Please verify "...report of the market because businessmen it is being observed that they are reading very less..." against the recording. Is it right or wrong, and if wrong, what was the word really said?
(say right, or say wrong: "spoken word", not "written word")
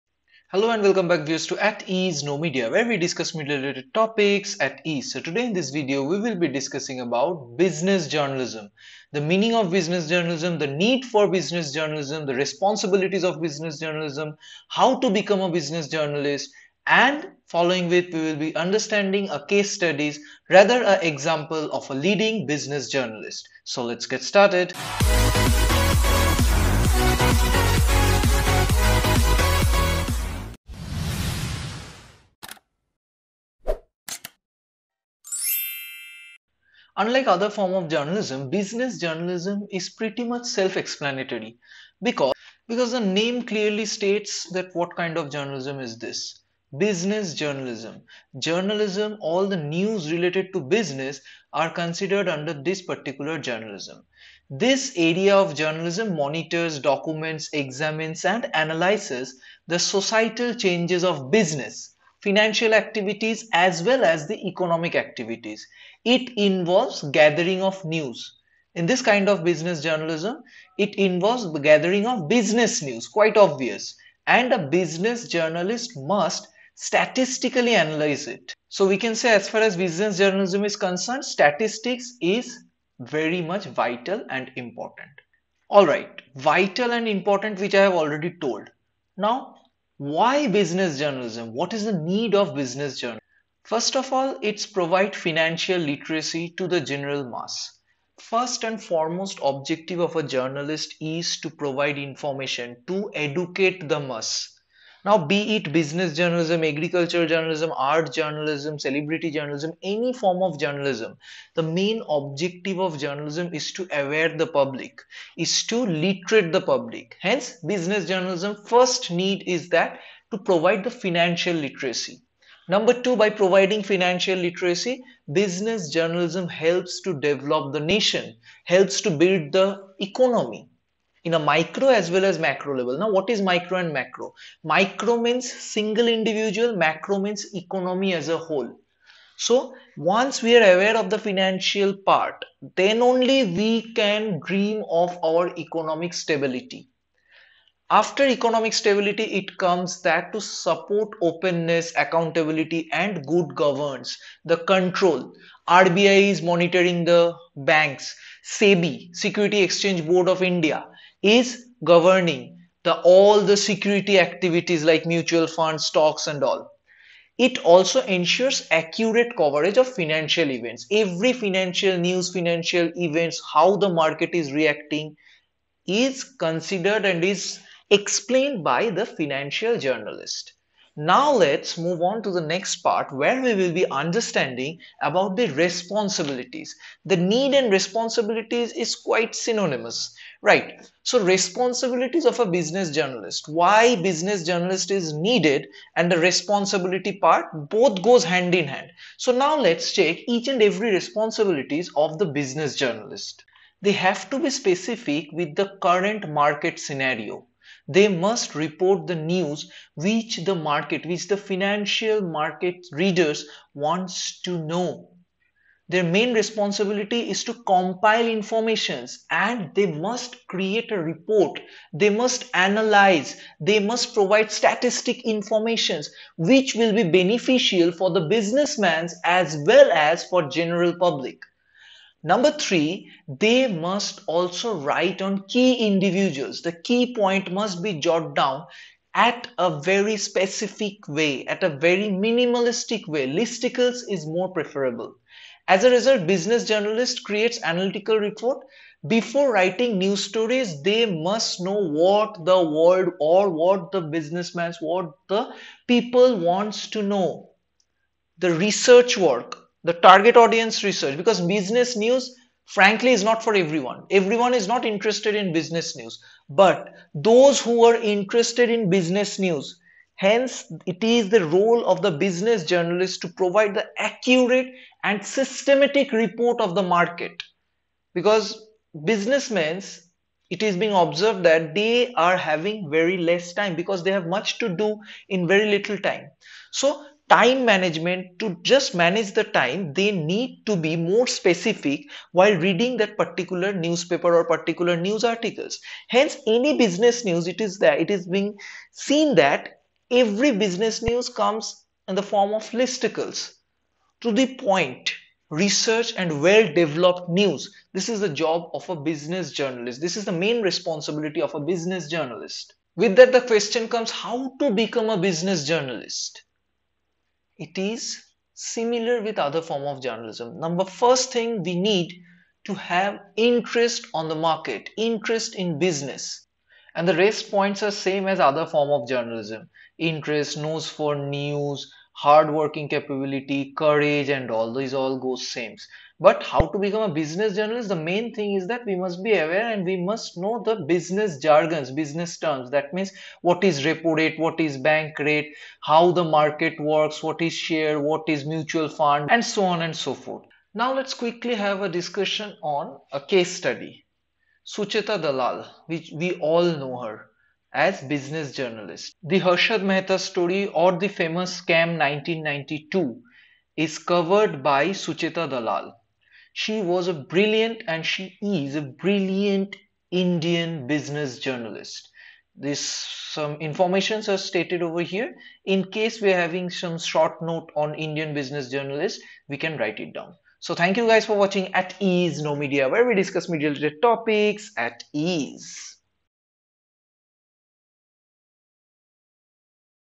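wrong: "having", not "reading".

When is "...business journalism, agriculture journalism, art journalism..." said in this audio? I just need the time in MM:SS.
01:45.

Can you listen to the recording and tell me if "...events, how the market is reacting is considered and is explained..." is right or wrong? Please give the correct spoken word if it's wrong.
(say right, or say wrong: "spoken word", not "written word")
right.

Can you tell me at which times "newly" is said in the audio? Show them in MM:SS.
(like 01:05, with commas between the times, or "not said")
not said.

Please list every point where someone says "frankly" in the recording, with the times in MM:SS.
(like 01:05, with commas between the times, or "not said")
04:22.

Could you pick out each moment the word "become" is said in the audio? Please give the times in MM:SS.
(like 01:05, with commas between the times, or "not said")
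00:15, 05:14, 05:36.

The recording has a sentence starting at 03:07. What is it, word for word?
The need and responsibilities is quite synonymous, right?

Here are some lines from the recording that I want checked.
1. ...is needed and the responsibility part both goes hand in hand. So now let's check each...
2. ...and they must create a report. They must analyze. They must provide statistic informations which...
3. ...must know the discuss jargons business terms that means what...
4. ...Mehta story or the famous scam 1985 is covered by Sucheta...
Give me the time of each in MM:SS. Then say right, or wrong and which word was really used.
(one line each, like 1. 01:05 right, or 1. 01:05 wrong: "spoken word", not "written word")
1. 03:14 right
2. 03:39 right
3. 05:40 wrong: "business", not "discuss"
4. 05:59 wrong: "1992", not "1985".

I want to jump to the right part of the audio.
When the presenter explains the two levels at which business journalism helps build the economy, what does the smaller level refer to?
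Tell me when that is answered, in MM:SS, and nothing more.
02:15.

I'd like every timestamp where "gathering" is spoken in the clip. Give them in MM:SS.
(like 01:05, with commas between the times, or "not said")
01:07, 01:11.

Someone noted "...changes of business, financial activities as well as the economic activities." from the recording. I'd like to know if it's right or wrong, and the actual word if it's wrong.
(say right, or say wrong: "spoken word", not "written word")
right.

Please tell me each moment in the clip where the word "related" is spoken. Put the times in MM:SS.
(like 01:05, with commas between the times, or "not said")
00:03, 00:50, 06:23.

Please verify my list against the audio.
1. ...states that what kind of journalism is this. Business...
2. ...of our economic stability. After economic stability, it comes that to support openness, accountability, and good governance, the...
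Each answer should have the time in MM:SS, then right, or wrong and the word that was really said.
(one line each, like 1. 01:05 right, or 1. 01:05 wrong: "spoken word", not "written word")
1. 00:43 right
2. 02:24 right.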